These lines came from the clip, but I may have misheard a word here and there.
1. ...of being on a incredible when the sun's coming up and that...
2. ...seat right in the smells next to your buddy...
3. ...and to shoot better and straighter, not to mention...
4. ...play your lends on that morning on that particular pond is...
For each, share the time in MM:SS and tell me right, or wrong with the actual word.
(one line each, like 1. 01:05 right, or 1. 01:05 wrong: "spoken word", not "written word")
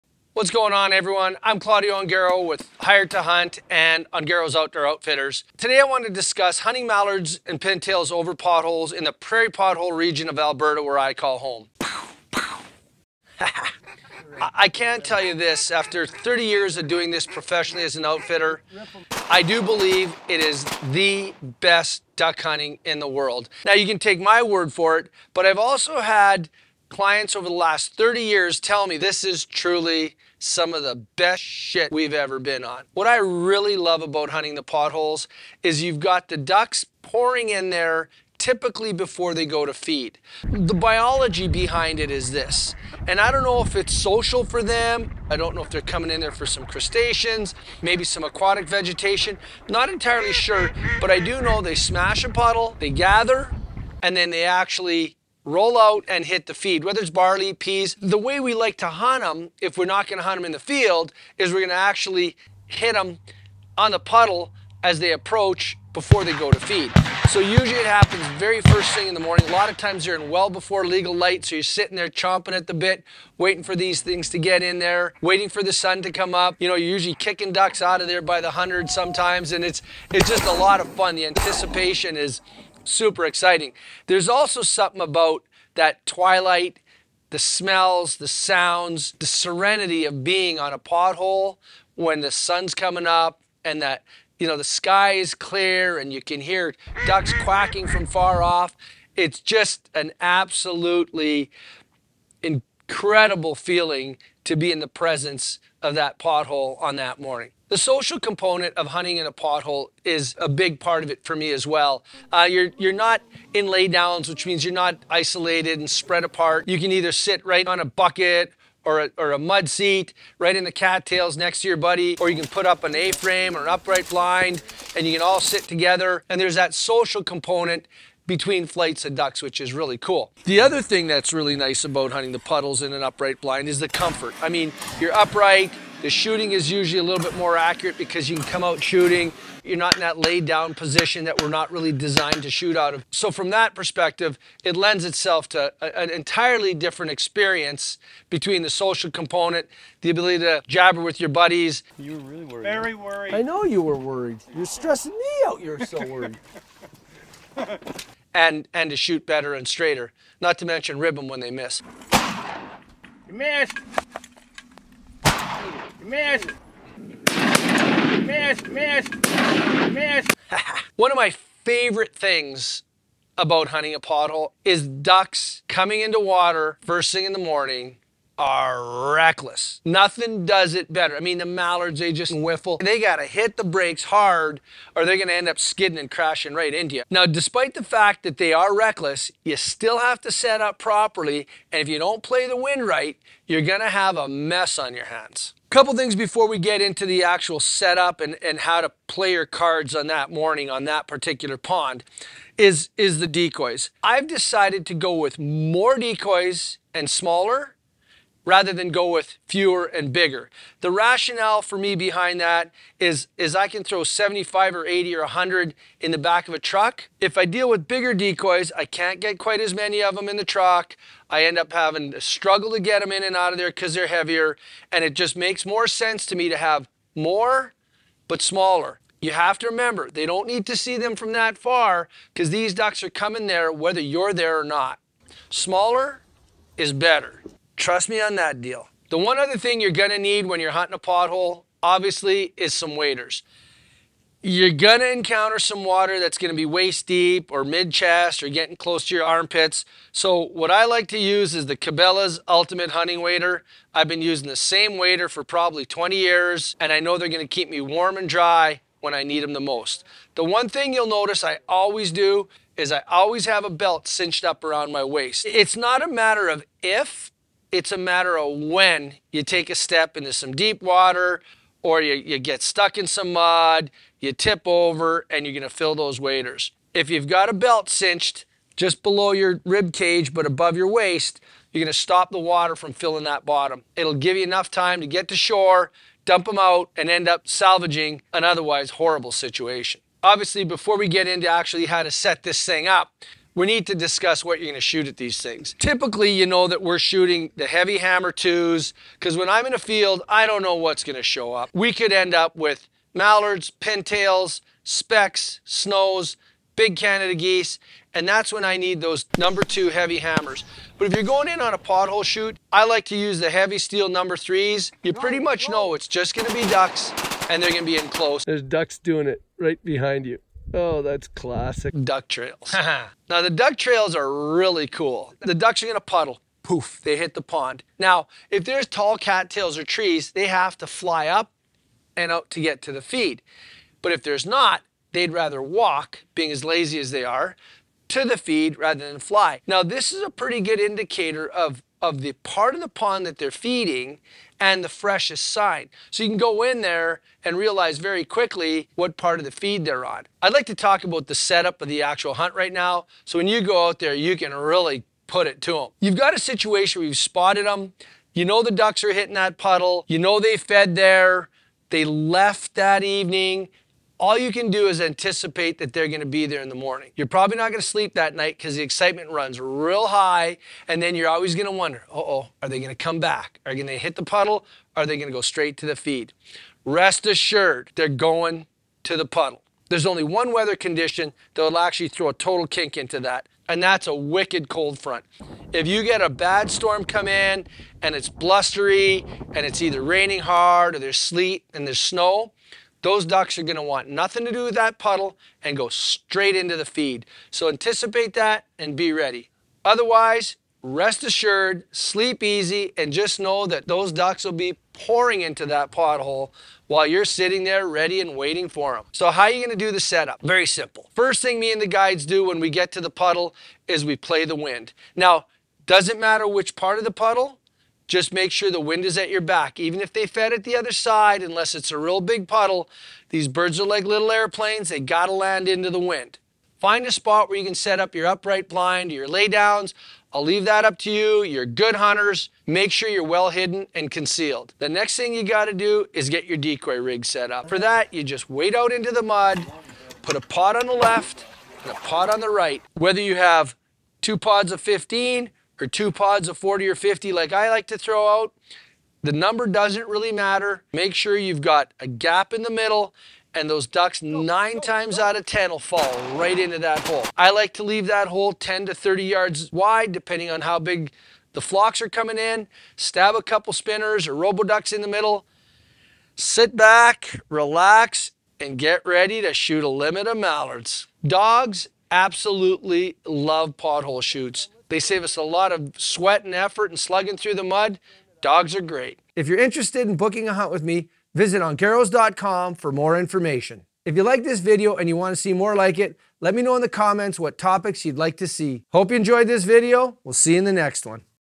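1. 01:30 wrong: "pothole", not "incredible"
2. 01:59 wrong: "cattails", not "smells"
3. 02:38 right
4. 03:19 wrong: "cards", not "lends".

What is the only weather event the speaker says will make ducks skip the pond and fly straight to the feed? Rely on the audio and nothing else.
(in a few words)
wicked cold front.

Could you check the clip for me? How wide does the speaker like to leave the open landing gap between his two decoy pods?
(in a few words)
10 to 30 yards.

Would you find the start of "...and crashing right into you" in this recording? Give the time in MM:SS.
03:05.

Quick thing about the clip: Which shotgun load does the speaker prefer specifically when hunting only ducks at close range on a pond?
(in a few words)
Hevi-Steel number threes.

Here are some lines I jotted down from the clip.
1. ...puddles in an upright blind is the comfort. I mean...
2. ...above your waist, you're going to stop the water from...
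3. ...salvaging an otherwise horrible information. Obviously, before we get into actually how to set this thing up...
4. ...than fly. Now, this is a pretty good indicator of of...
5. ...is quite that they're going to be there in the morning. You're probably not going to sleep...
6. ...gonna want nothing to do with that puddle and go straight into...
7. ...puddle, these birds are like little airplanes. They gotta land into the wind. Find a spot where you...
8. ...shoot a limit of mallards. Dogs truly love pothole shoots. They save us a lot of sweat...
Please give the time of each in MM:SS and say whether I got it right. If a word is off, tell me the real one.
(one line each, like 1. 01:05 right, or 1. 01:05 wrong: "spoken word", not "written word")
1. 02:12 right
2. 04:40 right
3. 04:47 wrong: "situation", not "information"
4. 05:39 right
5. 06:04 wrong: "anticipate", not "quite"
6. 06:33 right
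7. 07:02 right
8. 07:49 wrong: "absolutely", not "truly".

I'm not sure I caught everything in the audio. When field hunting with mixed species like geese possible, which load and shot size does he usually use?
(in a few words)
Hevi-Hammer twos.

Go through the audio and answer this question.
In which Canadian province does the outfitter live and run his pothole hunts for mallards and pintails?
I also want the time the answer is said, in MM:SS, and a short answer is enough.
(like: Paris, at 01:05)
Alberta, at 00:10.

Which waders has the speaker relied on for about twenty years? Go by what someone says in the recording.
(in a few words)
Cabela's Ultimate Hunting Wader.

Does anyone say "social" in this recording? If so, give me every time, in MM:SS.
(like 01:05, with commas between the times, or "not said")
00:43, 01:47, 02:06, 02:28.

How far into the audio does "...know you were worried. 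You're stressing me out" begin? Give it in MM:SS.
02:33.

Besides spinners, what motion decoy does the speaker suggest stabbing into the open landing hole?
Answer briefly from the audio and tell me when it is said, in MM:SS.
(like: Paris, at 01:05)
roboducks, at 07:44.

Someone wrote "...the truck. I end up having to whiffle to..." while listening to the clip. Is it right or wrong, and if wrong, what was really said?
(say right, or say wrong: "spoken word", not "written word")
wrong: "struggle", not "whiffle".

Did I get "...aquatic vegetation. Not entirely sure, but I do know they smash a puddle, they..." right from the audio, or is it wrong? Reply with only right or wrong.
right.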